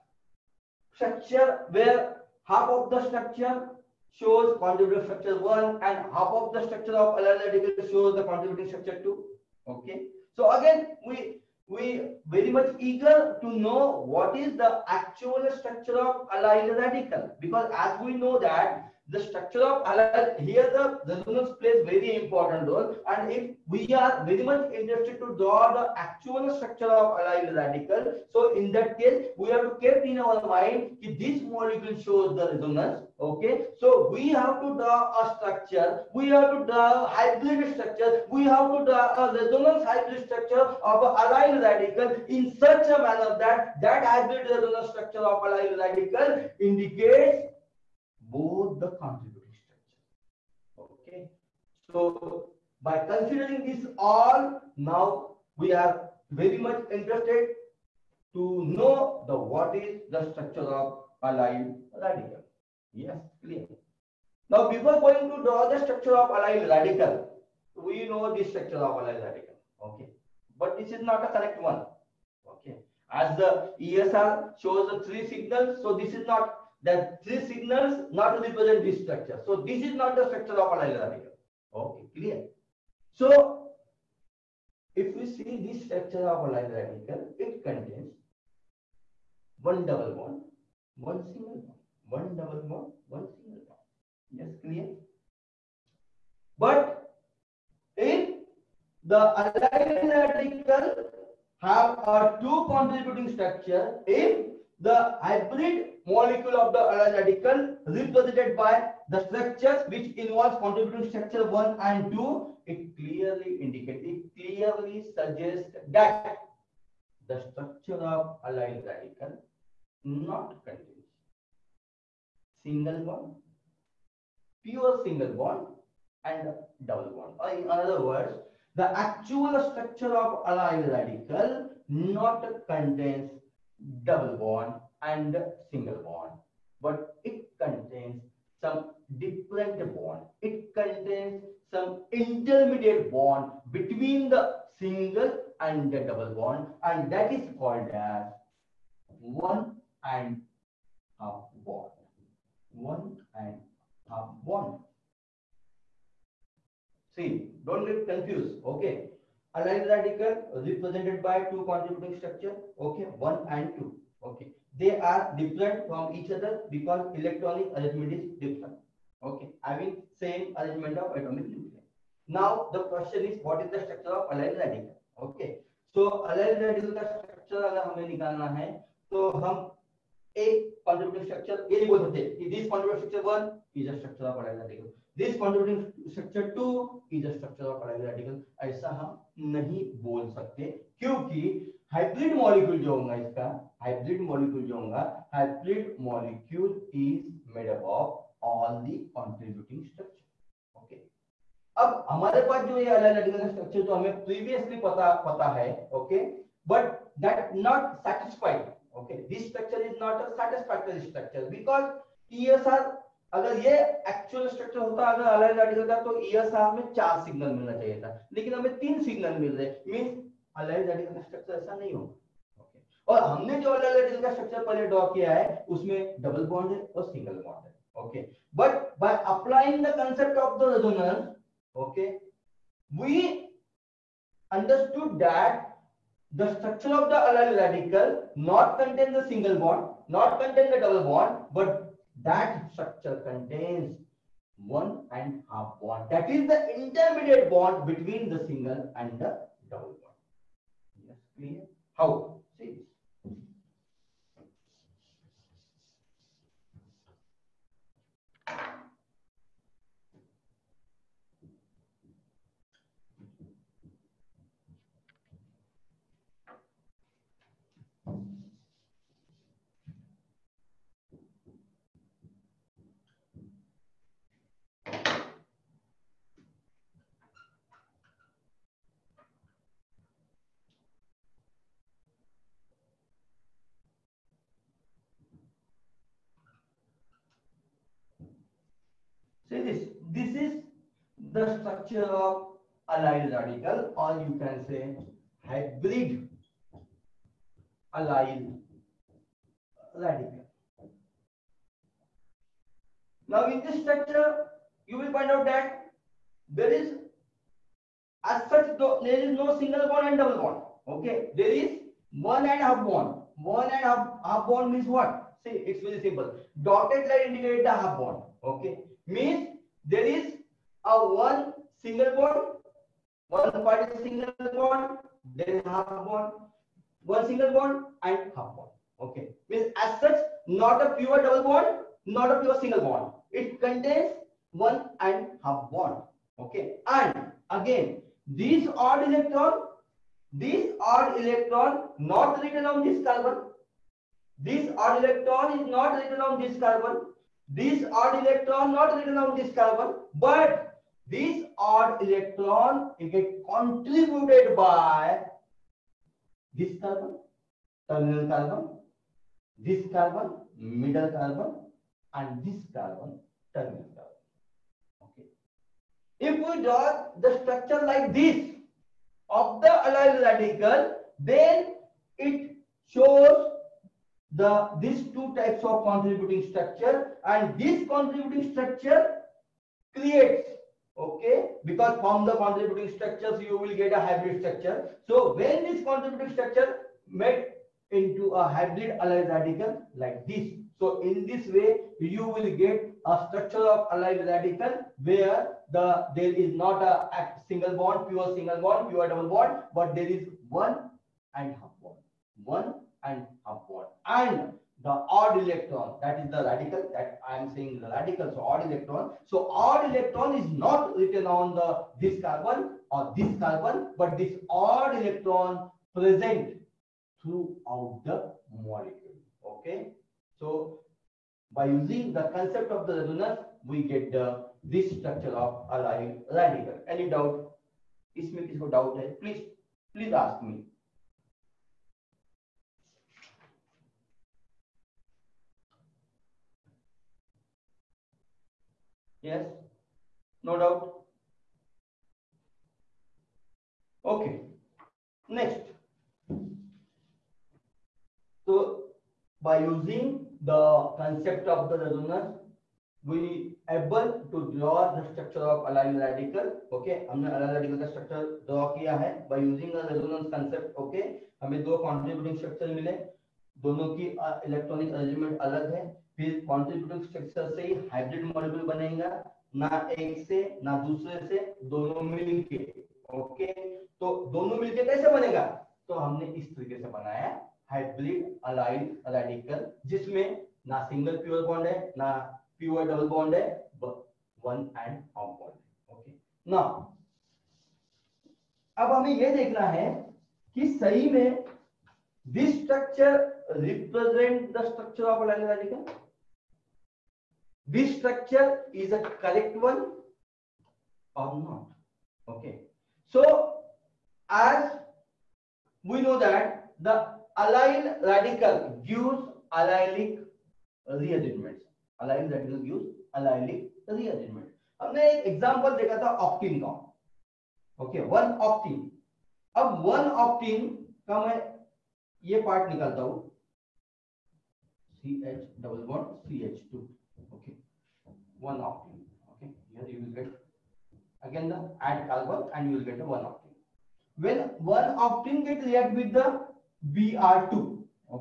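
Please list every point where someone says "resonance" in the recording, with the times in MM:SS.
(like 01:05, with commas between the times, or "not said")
00:21, 00:32, 00:39, 00:44, 07:03, 07:31, 07:39.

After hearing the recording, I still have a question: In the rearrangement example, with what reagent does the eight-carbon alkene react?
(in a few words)
Br2.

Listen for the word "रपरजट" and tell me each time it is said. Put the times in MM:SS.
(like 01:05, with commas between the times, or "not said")
08:13.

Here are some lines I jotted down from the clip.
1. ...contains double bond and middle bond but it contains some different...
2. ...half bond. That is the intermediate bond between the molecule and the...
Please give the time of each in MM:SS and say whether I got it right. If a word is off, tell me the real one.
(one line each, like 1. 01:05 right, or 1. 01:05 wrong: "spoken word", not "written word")
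1. 02:12 wrong: "single", not "middle"
2. 04:05 wrong: "single", not "molecule".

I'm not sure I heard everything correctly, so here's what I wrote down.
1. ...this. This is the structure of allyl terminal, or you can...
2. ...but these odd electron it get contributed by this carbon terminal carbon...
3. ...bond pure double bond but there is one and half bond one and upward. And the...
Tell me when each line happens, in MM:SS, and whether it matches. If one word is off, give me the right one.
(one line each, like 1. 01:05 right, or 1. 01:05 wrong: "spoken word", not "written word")
1. 04:49 wrong: "radical", not "terminal"
2. 05:50 right
3. 06:38 right.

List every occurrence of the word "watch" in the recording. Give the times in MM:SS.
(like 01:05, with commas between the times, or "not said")
not said.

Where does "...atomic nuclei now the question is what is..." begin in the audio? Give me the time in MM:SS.
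02:51.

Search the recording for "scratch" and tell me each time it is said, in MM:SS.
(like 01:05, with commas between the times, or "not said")
not said.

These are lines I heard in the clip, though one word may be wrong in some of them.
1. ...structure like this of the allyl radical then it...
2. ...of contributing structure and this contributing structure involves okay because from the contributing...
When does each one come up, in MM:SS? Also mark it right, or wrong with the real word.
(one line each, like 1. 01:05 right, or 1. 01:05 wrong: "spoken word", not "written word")
1. 06:07 right
2. 06:15 wrong: "creates", not "involves".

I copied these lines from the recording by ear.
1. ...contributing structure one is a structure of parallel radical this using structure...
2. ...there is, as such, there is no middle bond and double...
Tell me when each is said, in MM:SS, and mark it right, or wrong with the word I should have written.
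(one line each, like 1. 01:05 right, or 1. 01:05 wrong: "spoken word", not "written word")
1. 03:02 wrong: "contributing", not "using"
2. 05:06 wrong: "single", not "middle".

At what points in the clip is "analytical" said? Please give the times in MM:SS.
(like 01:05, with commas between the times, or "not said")
00:07.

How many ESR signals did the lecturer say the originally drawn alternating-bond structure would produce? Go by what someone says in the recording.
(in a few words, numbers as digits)
4.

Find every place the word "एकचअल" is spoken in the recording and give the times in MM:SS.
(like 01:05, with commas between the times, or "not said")
03:34.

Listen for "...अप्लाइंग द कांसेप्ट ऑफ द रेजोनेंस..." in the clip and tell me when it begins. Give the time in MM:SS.
03:49.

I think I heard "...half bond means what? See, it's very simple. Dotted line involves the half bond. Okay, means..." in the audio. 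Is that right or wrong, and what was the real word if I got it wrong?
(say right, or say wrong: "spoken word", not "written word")
wrong: "indicates", not "involves".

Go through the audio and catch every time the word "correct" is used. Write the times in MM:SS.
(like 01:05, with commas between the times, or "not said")
01:11, 08:19.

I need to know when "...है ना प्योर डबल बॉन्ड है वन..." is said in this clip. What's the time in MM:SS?
08:01.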